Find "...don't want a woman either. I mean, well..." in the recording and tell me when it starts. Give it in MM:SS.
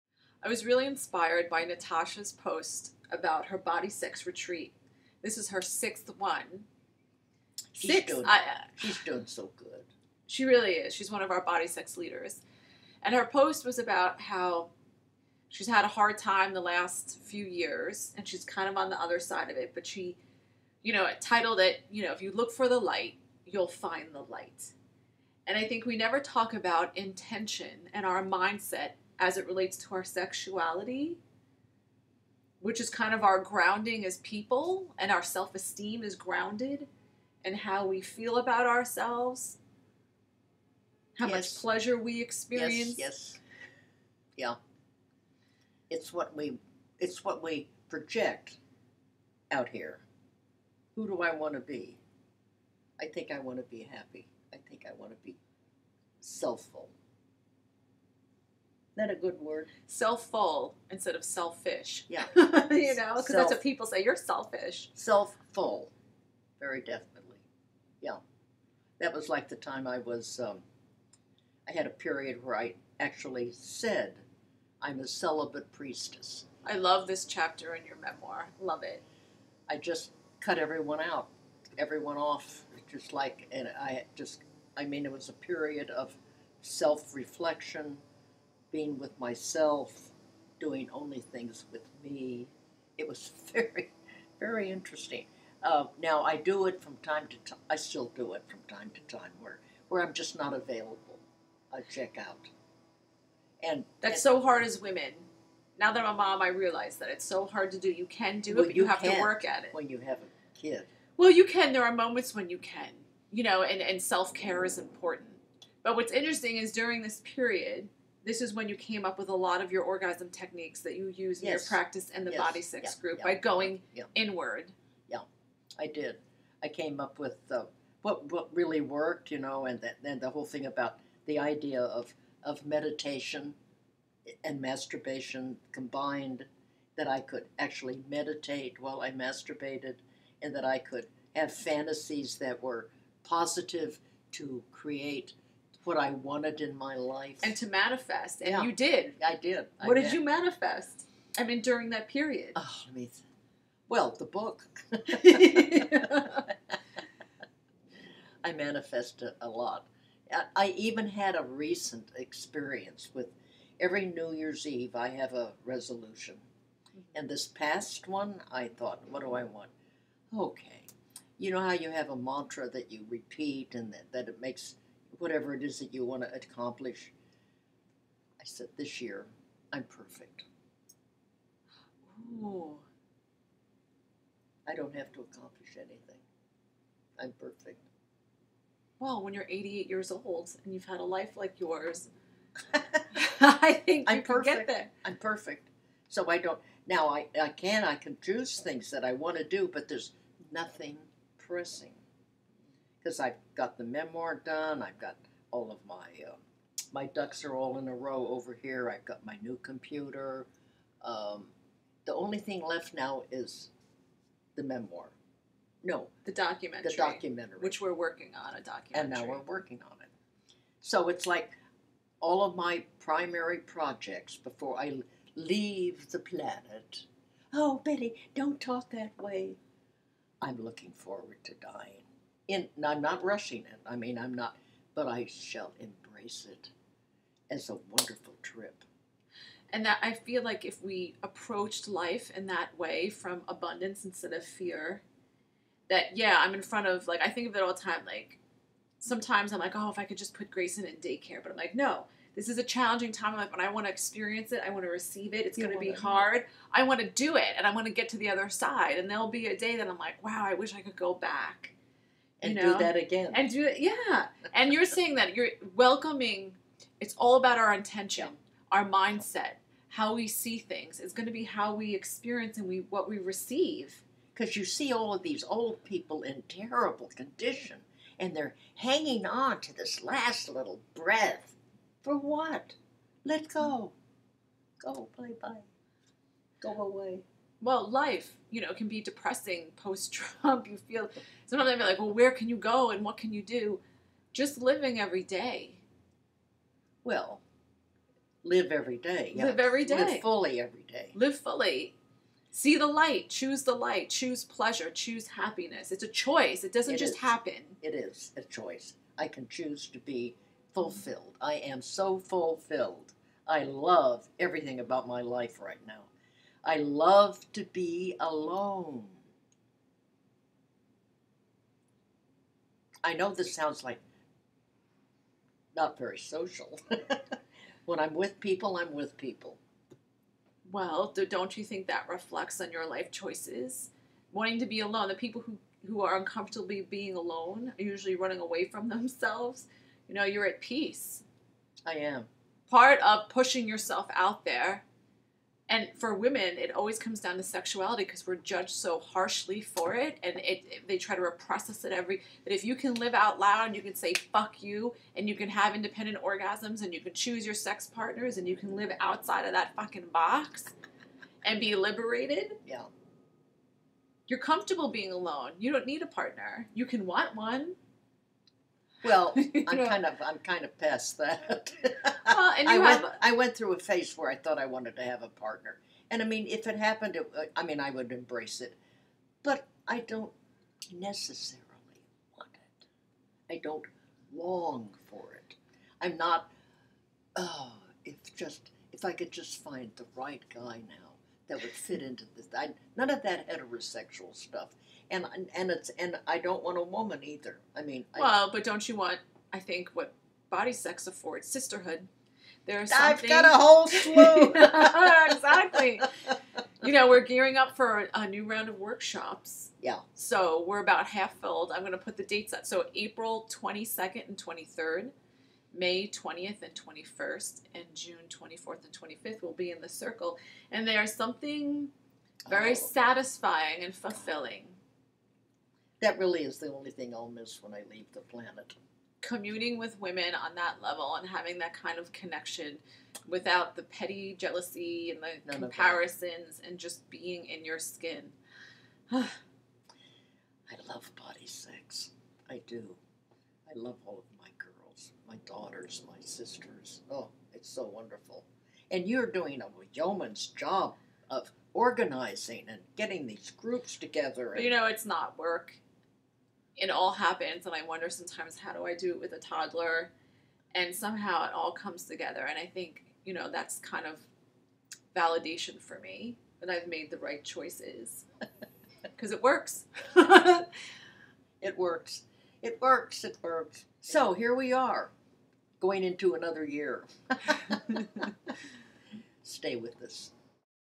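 06:36.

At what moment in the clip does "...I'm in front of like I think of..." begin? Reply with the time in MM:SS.
04:06.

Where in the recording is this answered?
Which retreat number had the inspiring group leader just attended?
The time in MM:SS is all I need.
00:05.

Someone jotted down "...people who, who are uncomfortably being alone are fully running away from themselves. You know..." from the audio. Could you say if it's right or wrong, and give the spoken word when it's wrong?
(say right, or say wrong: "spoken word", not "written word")
wrong: "usually", not "fully".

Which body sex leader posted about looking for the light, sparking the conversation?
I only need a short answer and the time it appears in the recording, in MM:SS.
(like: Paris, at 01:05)
Natasha, at 00:01.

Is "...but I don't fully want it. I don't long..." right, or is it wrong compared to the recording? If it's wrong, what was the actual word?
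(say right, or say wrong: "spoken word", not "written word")
wrong: "necessarily", not "fully".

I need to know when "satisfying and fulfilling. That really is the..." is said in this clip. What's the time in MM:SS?
07:02.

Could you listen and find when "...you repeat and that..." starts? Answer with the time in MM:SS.
02:52.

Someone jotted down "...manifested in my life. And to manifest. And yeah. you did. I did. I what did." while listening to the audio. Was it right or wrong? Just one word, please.
wrong.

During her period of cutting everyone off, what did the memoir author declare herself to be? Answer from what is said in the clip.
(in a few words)
celibate priestess.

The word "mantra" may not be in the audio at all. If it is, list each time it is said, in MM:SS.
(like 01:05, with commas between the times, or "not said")
02:52.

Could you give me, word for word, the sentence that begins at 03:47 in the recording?
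Oh, Betty, don't talk that way.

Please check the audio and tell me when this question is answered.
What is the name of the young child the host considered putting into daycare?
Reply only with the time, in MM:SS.
04:10.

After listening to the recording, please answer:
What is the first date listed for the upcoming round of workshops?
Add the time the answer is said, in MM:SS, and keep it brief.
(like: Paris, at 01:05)
April 22nd and 23rd, at 06:52.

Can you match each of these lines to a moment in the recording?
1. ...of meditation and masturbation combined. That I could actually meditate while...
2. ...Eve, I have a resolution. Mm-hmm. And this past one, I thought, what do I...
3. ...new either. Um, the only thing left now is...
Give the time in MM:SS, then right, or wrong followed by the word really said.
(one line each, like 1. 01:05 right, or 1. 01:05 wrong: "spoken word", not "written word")
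1. 02:12 right
2. 02:44 right
3. 03:29 wrong: "computer", not "either".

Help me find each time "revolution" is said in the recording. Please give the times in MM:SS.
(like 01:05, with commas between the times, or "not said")
not said.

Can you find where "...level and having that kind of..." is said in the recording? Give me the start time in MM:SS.
07:10.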